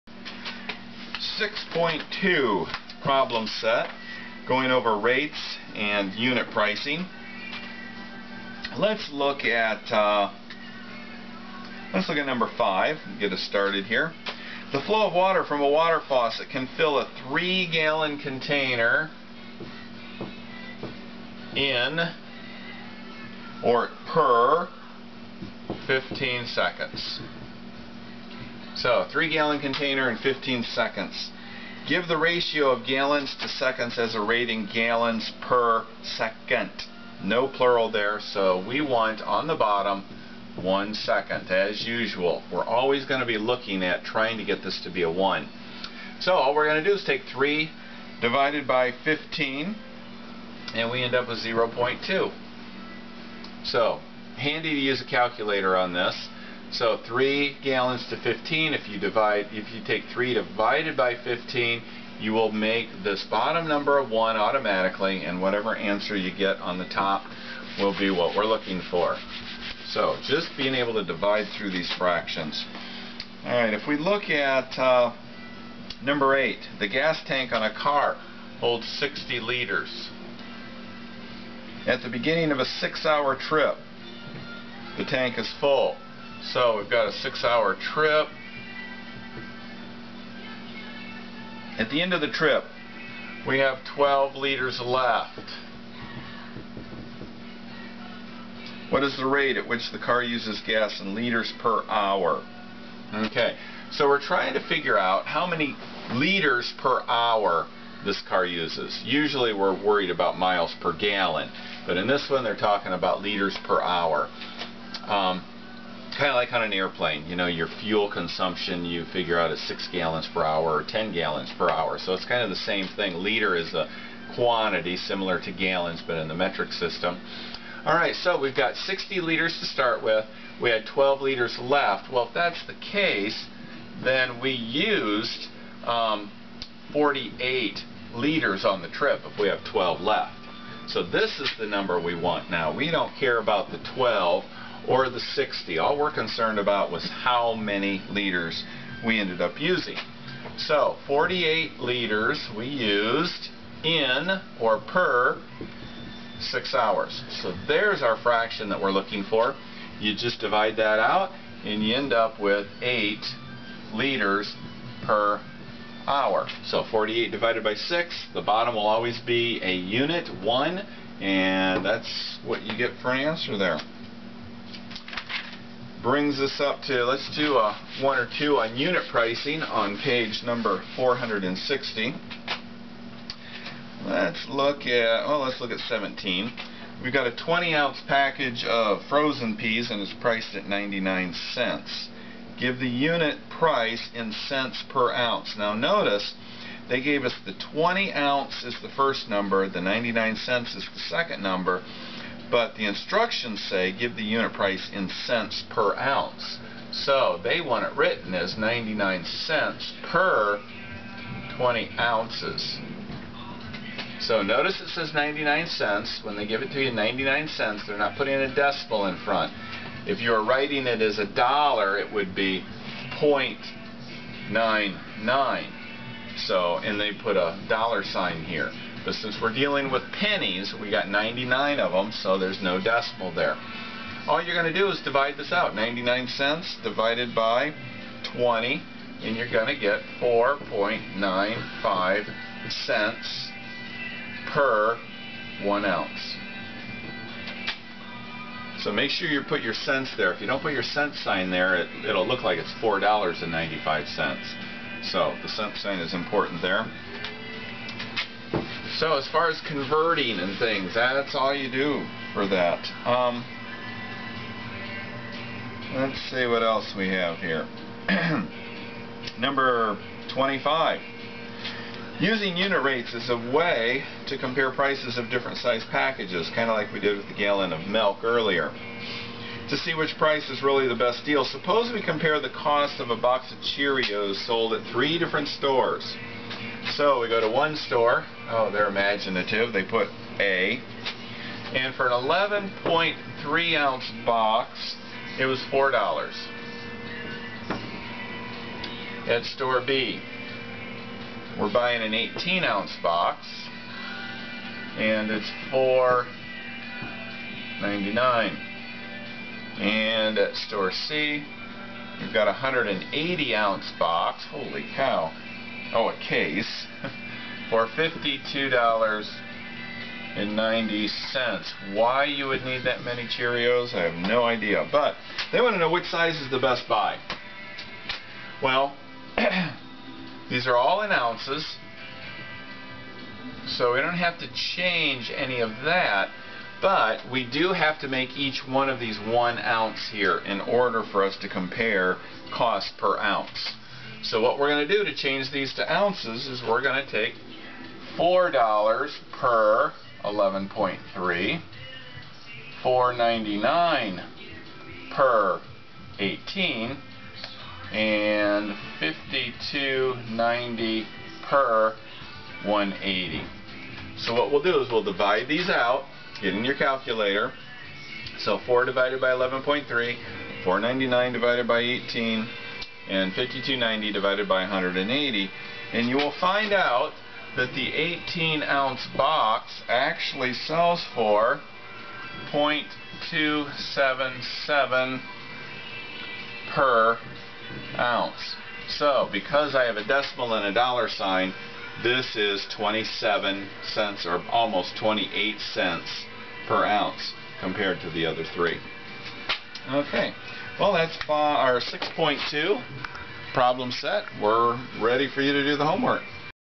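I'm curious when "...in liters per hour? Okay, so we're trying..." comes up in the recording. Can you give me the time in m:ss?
1:40.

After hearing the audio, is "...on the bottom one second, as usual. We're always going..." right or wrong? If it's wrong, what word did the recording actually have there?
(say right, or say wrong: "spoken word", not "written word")
right.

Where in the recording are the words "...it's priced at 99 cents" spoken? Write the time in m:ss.
3:10.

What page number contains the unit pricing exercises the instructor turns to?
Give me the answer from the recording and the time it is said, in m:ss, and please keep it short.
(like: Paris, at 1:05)
460, at 3:00.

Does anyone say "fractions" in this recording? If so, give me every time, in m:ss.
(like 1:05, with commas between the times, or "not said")
1:11, 2:38.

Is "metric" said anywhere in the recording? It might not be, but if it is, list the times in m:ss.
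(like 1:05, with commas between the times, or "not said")
2:06.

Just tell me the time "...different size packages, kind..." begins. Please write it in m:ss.
4:35.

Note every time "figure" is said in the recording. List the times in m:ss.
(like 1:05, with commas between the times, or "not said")
1:44, 1:59.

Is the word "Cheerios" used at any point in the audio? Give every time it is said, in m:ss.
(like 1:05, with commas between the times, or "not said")
4:43, 5:23.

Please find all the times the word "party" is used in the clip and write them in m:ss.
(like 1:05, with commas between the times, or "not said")
not said.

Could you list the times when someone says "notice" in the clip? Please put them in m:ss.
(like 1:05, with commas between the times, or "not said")
3:15, 3:34.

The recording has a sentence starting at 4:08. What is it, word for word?
So make sure you put your cents there.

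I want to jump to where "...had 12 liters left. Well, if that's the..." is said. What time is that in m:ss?
2:10.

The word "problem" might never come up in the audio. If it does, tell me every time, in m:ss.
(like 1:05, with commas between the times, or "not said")
0:03, 6:43.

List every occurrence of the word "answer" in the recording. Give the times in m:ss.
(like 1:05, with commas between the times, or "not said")
1:05, 2:53.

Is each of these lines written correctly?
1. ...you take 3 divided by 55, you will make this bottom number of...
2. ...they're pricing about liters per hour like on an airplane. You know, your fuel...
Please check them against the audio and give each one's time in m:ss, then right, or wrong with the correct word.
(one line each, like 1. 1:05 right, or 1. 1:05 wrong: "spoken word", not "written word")
1. 0:59 wrong: "15", not "55"
2. 1:52 wrong: "talking", not "pricing".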